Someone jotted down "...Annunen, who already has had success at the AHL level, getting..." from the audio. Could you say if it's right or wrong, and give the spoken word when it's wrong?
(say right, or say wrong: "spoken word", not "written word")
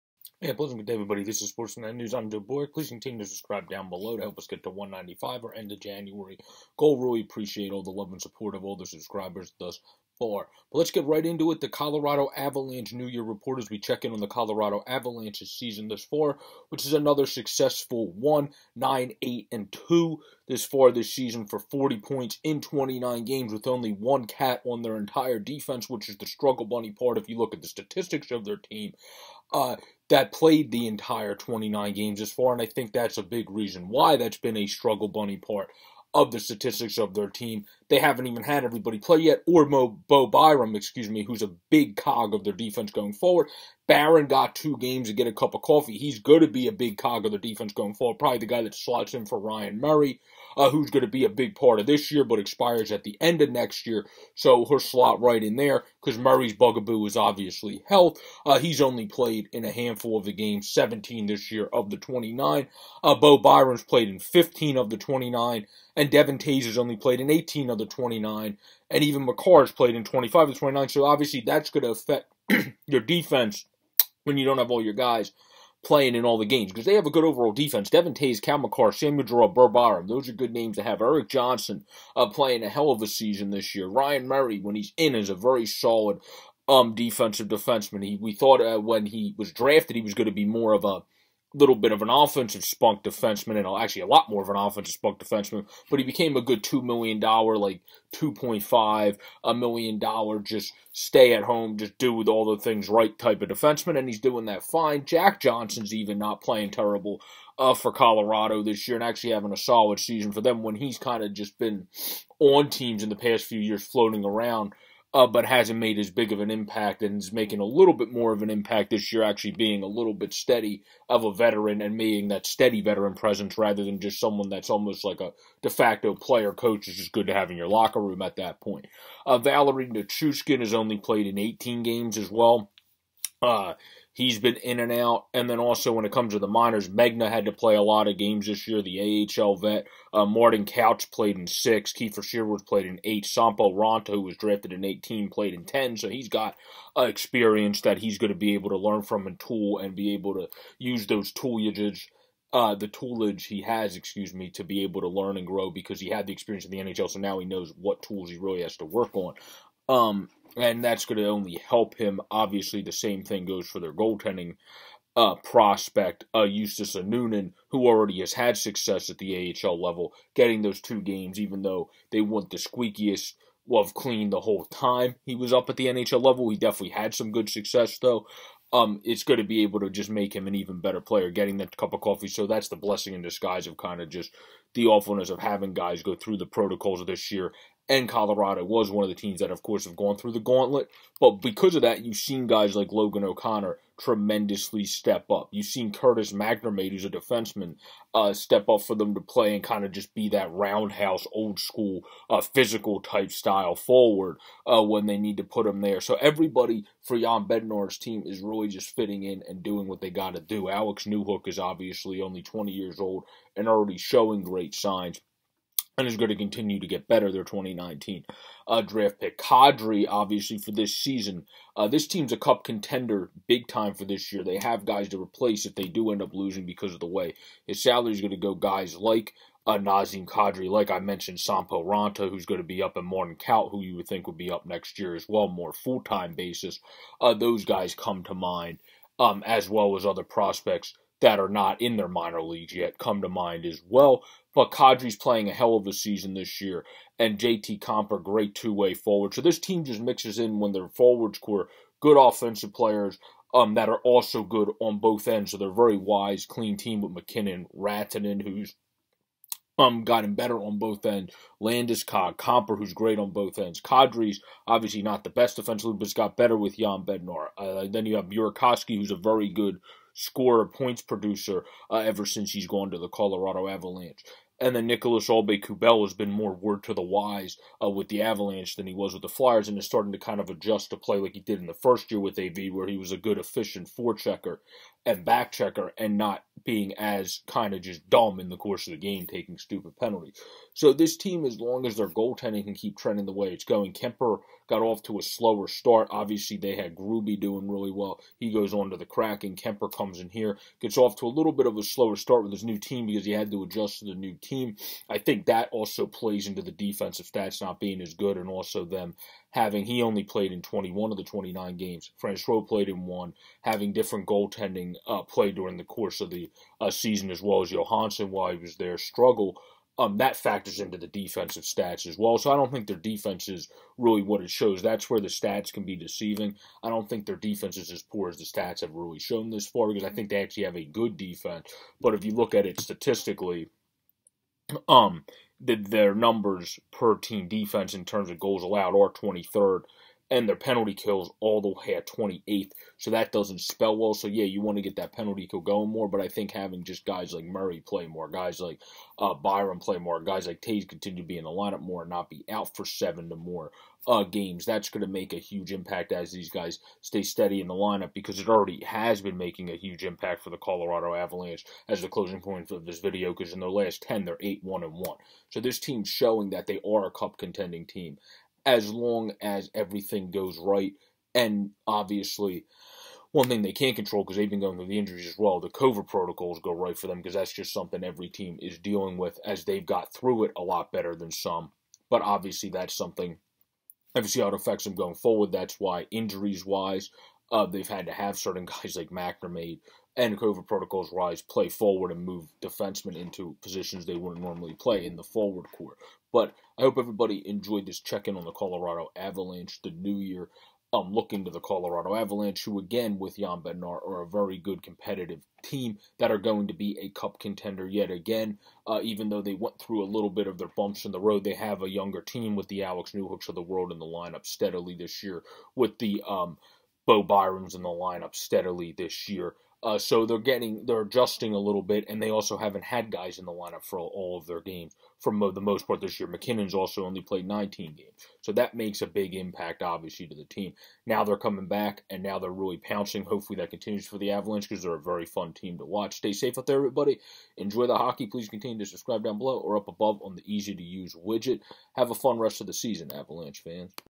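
right.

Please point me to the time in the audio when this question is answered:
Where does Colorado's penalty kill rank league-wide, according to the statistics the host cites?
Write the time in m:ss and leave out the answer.
5:42.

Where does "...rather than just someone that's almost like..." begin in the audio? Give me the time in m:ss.
2:03.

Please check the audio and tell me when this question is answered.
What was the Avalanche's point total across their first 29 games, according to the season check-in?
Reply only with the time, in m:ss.
0:21.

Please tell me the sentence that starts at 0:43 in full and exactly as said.
Barron got two games to get a cup of coffee.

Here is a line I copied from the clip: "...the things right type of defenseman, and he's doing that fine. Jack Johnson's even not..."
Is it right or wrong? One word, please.
right.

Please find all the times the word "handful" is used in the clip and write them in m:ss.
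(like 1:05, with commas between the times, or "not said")
0:59.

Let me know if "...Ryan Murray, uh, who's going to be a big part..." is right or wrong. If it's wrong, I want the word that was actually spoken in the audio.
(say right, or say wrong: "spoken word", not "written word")
right.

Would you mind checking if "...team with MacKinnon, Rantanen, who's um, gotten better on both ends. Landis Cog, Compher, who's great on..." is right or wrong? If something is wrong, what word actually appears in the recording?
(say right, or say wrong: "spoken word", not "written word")
right.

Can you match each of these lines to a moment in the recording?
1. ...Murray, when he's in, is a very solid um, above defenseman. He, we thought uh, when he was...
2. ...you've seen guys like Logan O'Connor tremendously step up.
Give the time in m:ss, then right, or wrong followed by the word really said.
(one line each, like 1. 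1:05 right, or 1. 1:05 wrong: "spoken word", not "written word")
1. 1:24 wrong: "defensive", not "above"
2. 3:12 right.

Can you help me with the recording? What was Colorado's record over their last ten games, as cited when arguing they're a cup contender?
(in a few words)
8-1-1.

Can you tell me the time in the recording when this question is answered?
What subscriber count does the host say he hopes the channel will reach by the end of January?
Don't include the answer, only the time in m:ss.
0:04.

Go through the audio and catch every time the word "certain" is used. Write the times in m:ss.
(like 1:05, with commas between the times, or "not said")
6:28.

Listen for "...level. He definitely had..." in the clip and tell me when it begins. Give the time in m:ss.
2:56.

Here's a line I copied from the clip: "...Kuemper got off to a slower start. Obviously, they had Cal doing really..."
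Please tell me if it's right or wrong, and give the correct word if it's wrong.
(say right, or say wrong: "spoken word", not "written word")
wrong: "Gruby", not "Cal".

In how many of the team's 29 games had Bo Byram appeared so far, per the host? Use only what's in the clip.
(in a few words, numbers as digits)
15.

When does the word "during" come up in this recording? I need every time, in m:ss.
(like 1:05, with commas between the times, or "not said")
5:15.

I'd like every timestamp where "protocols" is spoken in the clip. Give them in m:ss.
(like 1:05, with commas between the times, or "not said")
3:06, 6:16, 6:30.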